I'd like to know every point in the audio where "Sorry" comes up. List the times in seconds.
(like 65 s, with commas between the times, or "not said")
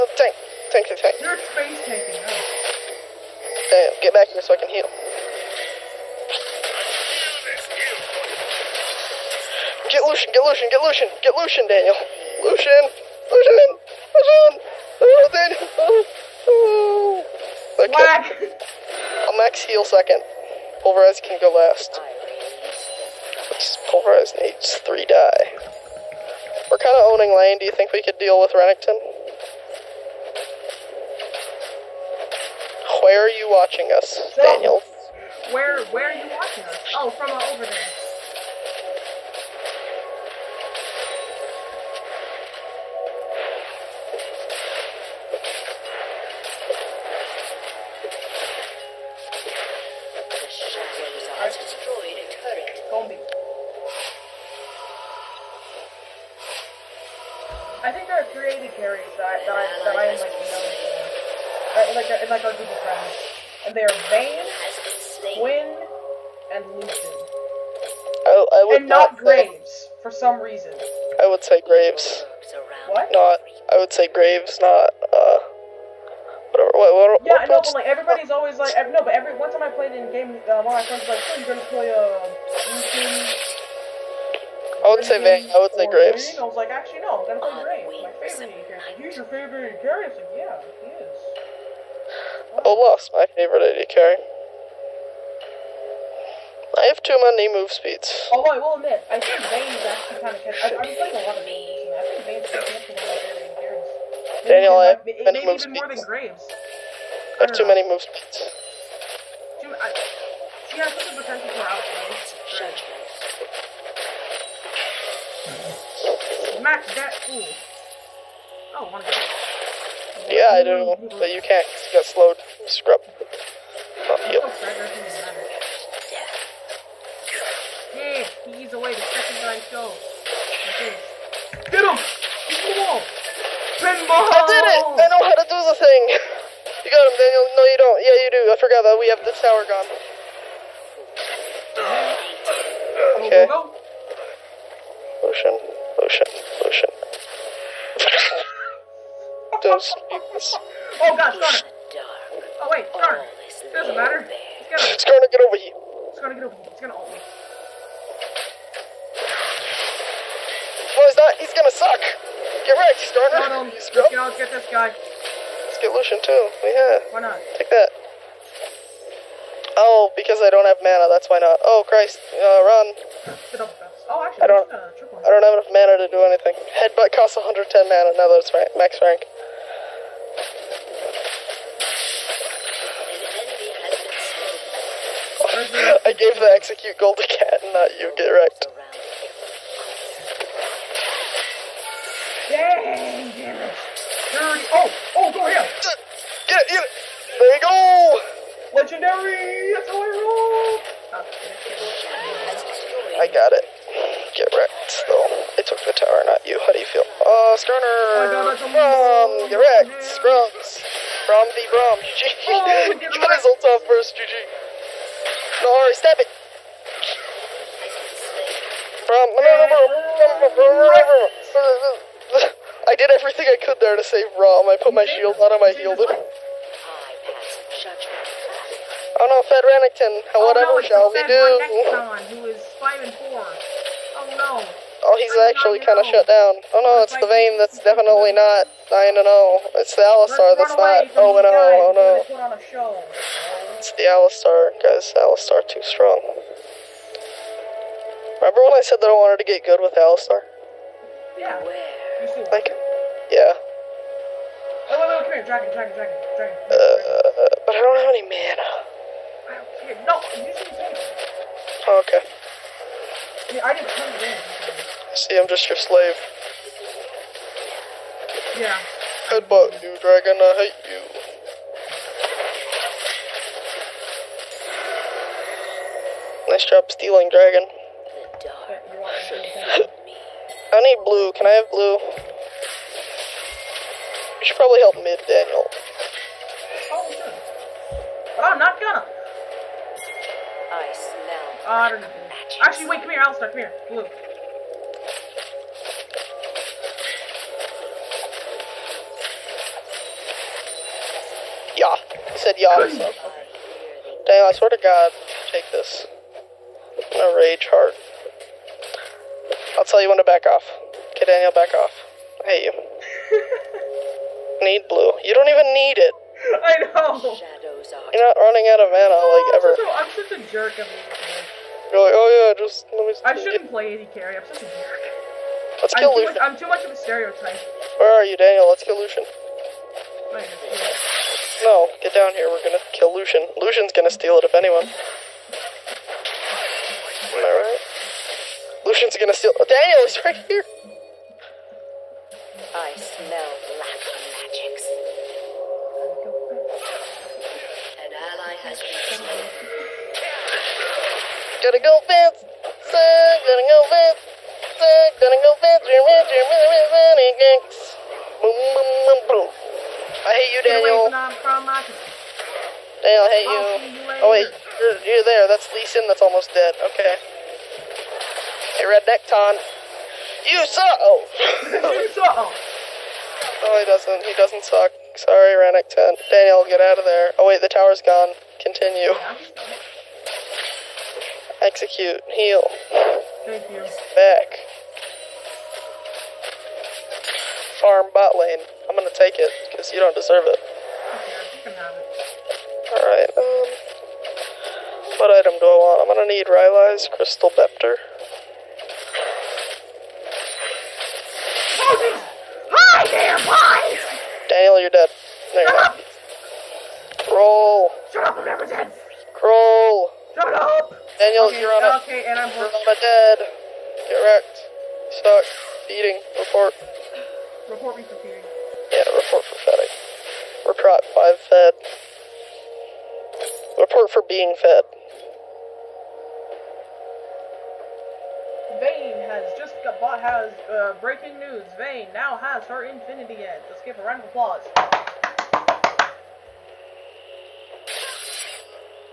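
215 s, 375 s.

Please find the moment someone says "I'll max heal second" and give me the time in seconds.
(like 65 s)
19 s.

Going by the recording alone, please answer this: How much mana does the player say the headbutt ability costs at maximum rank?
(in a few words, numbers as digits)
110.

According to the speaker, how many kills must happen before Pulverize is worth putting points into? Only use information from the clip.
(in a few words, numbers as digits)
3.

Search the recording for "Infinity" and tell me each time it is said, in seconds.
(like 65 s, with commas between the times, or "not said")
432 s.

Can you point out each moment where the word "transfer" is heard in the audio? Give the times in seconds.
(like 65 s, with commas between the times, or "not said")
not said.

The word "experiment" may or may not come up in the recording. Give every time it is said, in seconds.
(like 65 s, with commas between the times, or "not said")
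not said.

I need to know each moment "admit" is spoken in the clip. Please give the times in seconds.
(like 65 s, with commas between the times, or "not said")
98 s.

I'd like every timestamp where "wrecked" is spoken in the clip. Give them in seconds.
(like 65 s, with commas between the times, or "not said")
162 s, 188 s, 204 s, 209 s, 414 s.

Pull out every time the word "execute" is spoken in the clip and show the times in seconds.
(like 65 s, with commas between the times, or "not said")
186 s, 381 s.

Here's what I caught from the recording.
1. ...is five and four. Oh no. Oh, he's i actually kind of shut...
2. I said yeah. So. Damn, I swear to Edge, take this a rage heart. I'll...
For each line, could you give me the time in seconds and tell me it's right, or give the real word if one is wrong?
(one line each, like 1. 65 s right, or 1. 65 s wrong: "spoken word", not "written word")
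1. 232 s right
2. 302 s wrong: "God", not "Edge".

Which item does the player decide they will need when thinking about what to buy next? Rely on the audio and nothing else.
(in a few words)
Rylai's Crystal Scepter.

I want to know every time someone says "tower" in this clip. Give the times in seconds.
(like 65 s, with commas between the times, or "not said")
139 s, 205 s, 377 s.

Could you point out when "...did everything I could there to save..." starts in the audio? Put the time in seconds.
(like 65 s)
222 s.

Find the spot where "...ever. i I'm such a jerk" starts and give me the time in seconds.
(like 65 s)
319 s.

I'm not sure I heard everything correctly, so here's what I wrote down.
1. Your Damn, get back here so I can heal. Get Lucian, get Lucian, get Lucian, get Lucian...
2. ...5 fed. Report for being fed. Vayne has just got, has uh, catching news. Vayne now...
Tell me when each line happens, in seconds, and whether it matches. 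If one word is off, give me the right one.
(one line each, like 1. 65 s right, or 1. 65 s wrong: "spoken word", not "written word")
1. 1 s right
2. 421 s wrong: "breaking", not "catching".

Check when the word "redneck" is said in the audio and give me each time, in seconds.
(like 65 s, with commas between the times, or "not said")
368 s, 375 s.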